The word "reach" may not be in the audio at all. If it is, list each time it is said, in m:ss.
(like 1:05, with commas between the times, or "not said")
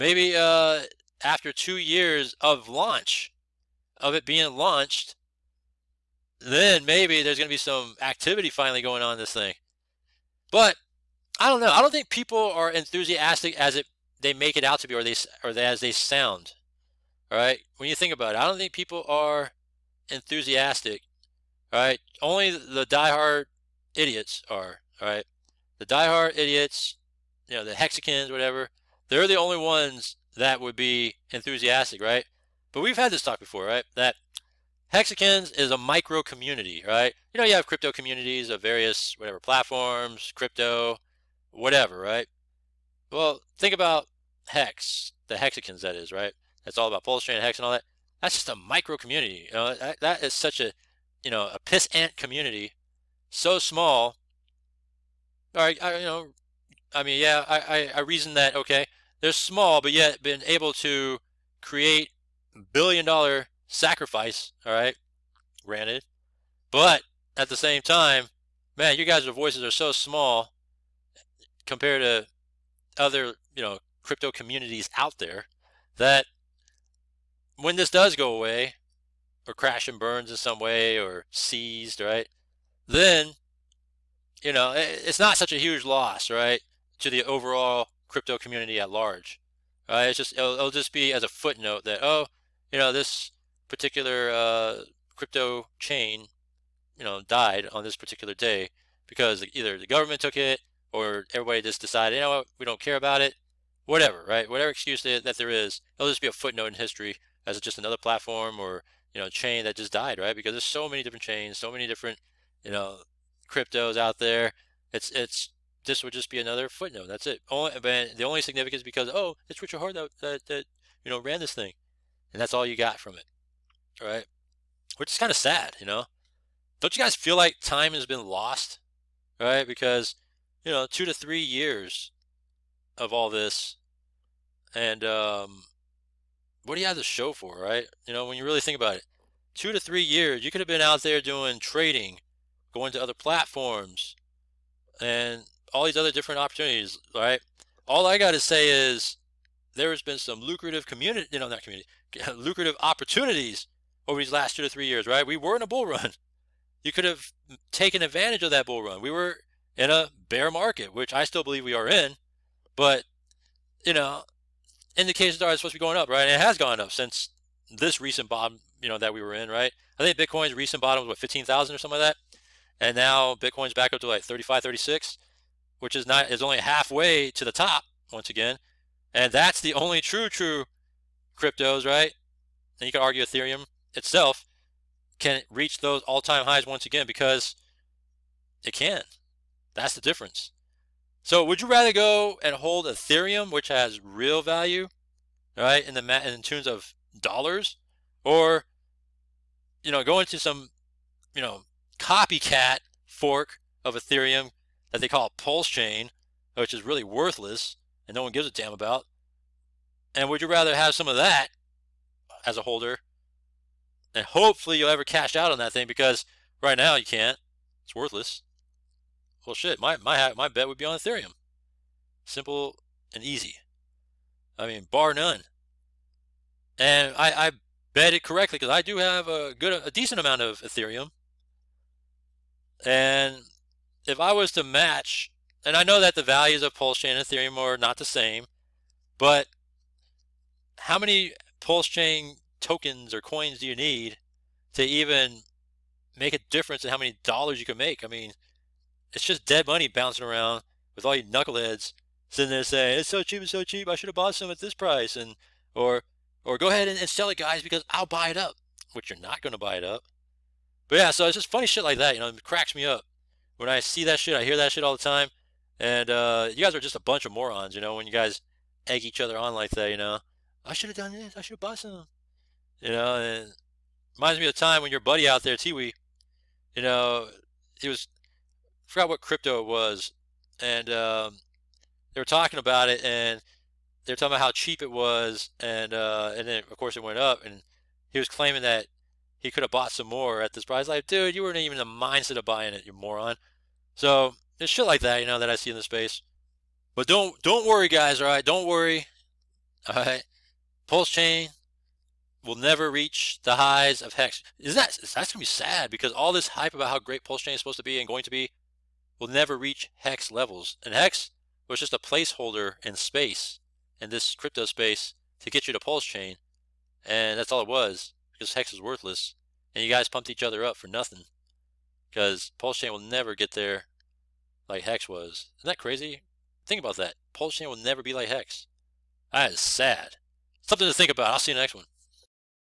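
3:05, 5:02, 5:09.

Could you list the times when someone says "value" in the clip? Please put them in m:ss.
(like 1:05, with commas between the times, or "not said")
3:14, 3:56.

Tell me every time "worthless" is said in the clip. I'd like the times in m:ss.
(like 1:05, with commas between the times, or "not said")
3:27, 3:37, 5:18.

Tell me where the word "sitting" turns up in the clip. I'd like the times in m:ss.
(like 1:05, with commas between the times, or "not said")
4:12.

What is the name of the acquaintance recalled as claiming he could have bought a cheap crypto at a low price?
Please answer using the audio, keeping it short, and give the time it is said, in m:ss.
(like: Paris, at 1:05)
Tiwi, at 4:35.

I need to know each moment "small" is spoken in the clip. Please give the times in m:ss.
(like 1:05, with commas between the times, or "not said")
0:53, 0:59, 1:09.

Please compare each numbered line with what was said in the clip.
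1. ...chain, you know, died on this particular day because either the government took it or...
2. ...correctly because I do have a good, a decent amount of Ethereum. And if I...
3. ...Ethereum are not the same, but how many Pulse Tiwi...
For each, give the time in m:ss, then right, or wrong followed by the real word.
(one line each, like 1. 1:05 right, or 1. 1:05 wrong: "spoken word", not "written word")
1. 1:35 right
2. 3:48 right
3. 3:57 wrong: "Chain", not "Tiwi".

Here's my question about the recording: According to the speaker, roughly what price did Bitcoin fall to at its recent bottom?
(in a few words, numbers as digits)
15,000.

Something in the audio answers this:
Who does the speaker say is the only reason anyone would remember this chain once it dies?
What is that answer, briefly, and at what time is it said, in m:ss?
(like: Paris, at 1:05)
Richard Hart, at 1:59.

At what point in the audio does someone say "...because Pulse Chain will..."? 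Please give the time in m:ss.
5:22.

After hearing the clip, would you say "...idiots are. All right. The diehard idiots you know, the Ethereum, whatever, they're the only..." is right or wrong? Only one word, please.
wrong.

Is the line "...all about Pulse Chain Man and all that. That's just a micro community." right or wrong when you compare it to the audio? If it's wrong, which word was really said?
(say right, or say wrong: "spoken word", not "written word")
wrong: "Hex", not "Man".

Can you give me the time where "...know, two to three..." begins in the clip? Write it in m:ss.
2:10.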